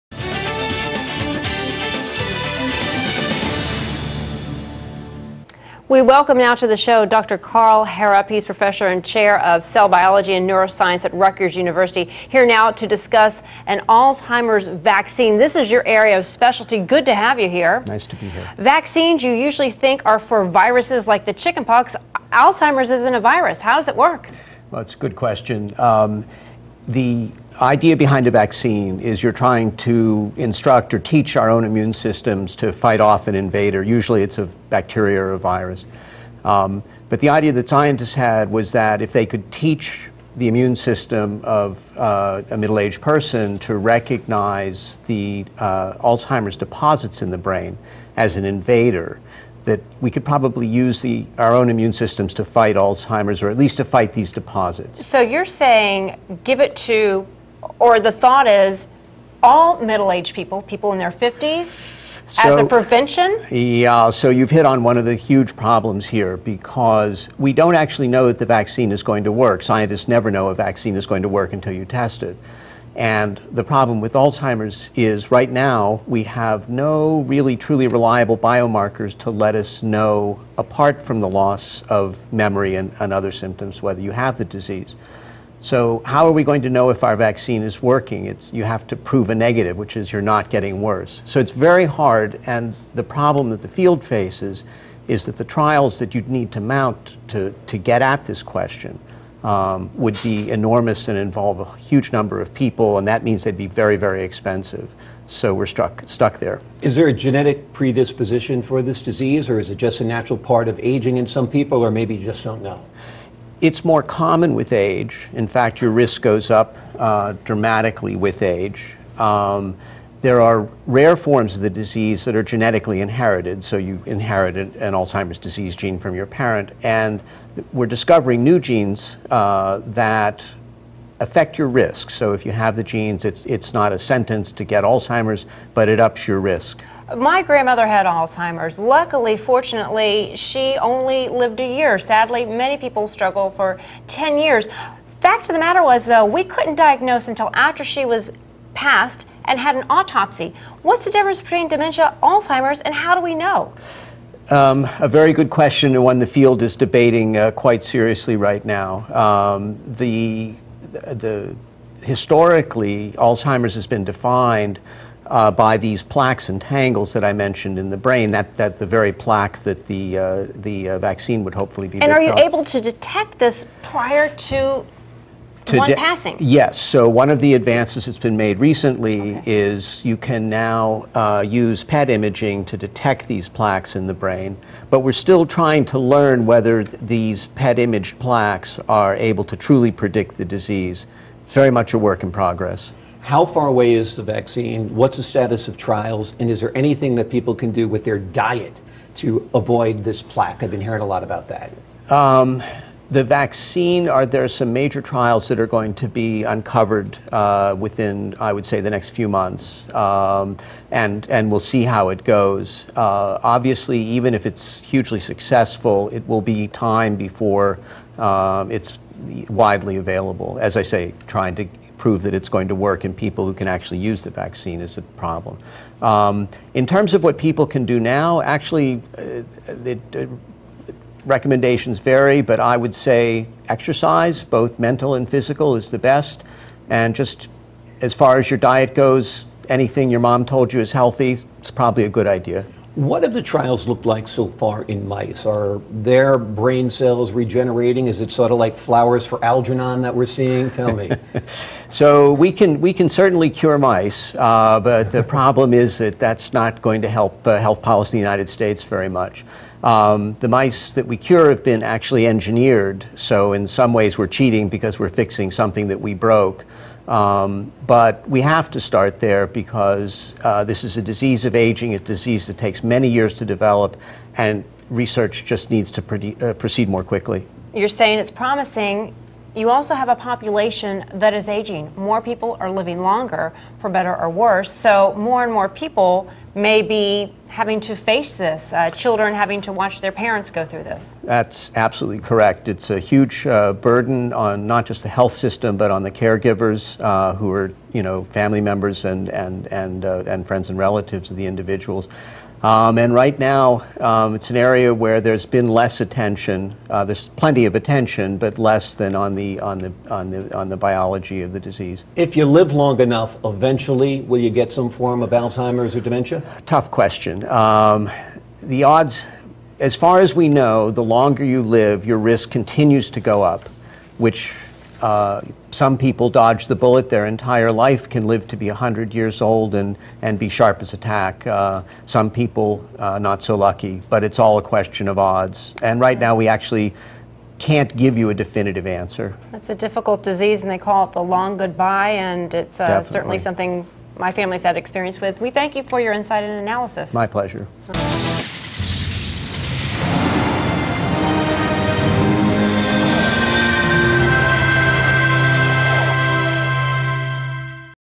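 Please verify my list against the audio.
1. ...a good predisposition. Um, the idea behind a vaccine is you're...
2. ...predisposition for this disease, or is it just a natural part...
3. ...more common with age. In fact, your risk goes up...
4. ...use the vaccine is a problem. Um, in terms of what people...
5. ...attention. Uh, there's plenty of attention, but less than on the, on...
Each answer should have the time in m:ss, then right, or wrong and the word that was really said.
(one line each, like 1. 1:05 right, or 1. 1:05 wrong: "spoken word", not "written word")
1. 0:24 wrong: "question", not "predisposition"
2. 1:47 right
3. 1:53 right
4. 3:43 right
5. 5:05 right.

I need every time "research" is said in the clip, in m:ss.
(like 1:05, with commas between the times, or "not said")
4:34.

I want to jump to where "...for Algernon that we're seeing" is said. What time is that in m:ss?
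4:09.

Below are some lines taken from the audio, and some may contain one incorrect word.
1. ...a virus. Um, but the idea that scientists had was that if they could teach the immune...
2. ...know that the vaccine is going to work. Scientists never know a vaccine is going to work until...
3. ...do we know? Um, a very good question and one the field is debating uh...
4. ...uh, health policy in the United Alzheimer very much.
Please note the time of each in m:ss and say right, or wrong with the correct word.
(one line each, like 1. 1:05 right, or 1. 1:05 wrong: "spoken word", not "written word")
1. 0:35 right
2. 1:08 right
3. 2:33 right
4. 4:17 wrong: "States", not "Alzheimer".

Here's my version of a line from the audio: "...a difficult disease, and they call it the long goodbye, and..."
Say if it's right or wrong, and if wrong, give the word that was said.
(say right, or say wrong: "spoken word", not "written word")
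right.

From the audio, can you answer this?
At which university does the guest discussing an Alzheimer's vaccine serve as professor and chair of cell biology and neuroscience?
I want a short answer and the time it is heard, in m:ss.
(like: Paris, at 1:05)
Rutgers University, at 0:11.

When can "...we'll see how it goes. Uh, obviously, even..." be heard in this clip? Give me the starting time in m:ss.
3:31.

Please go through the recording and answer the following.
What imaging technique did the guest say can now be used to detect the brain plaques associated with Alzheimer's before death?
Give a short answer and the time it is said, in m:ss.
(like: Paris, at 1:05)
PET imaging, at 3:01.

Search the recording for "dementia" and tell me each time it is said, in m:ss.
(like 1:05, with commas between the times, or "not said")
2:31, 5:16.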